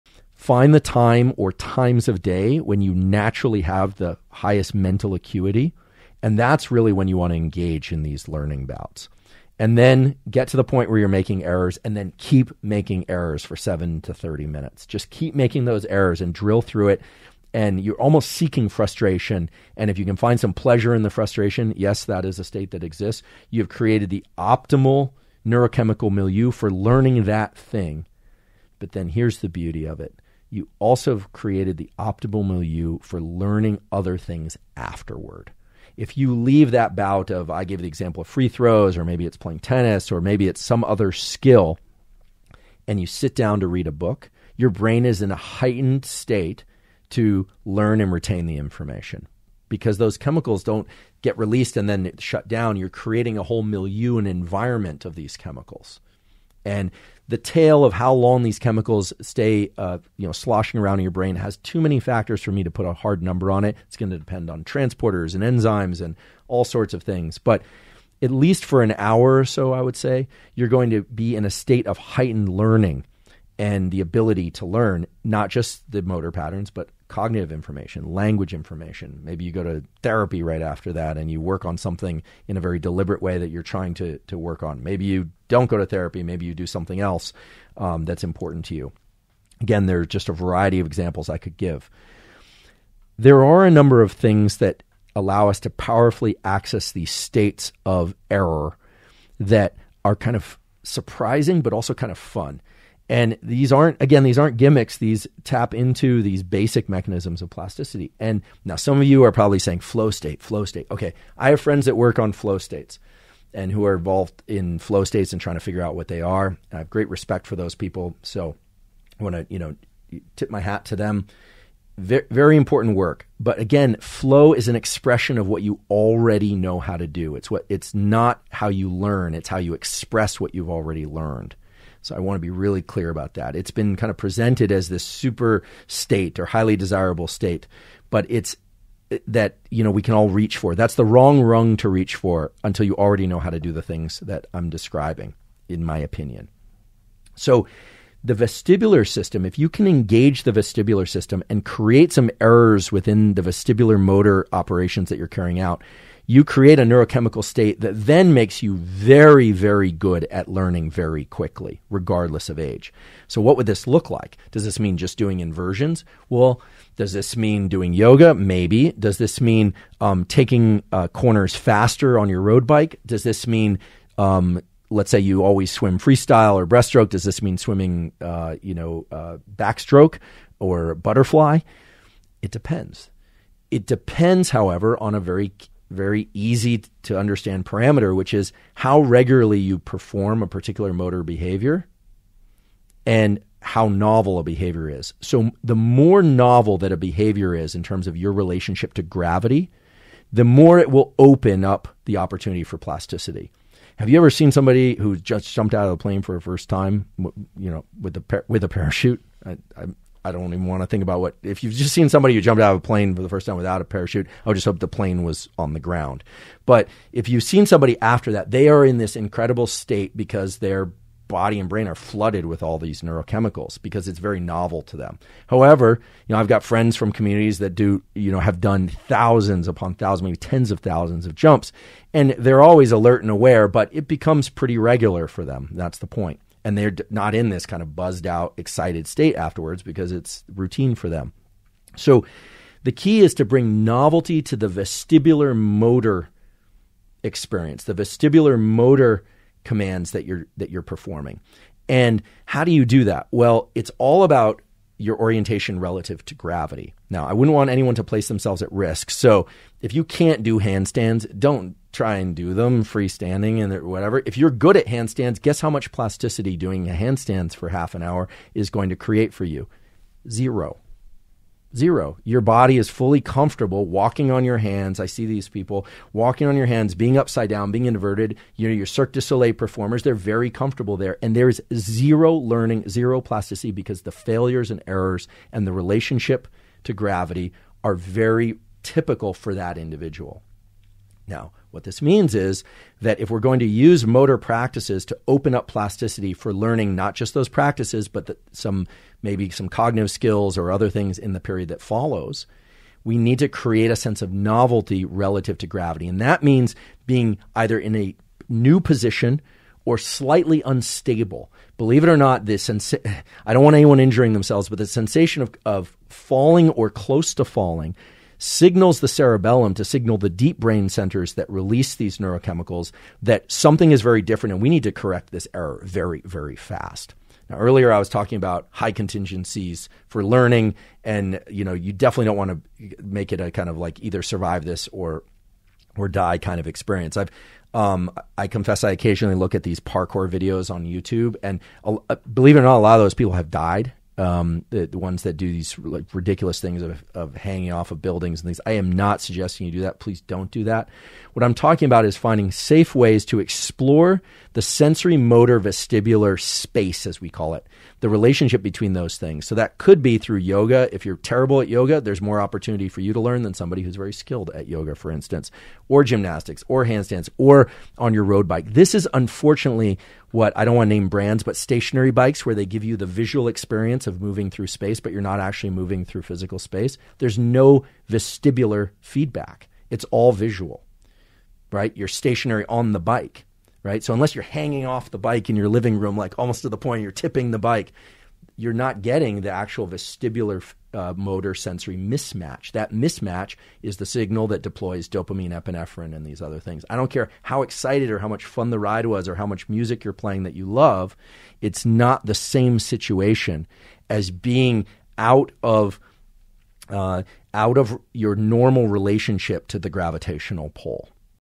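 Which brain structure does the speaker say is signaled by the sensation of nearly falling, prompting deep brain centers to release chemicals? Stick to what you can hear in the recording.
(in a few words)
cerebellum.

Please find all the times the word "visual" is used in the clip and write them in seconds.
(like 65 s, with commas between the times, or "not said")
373 s, 380 s.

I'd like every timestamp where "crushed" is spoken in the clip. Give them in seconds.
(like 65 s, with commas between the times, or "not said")
not said.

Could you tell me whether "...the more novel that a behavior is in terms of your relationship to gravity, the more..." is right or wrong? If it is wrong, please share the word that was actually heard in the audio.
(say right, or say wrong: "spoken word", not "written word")
right.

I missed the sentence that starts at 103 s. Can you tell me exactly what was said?
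And these aren't, again, these aren't gimmicks.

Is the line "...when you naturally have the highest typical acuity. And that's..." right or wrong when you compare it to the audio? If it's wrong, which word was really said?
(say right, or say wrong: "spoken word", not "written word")
wrong: "mental", not "typical".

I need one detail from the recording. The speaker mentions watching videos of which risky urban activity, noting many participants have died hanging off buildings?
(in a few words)
parkour.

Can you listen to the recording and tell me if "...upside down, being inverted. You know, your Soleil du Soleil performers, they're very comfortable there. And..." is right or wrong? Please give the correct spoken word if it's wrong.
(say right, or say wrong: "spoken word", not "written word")
wrong: "Cirque", not "Soleil".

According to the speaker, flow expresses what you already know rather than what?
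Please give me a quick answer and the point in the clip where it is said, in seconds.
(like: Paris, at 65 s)
how you learn, at 128 s.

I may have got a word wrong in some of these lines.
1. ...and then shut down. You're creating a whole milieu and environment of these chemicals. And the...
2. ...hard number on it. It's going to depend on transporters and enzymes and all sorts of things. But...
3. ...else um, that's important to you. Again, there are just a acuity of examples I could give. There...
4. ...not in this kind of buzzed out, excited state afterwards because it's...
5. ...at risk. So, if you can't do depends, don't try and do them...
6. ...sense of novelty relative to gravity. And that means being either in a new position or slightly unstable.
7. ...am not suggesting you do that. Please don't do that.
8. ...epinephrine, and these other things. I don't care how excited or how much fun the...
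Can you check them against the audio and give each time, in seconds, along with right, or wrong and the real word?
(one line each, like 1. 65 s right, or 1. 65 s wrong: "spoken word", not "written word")
1. 51 s right
2. 62 s right
3. 87 s wrong: "variety", not "acuity"
4. 237 s right
5. 258 s wrong: "handstands", not "depends"
6. 303 s right
7. 348 s right
8. 395 s right.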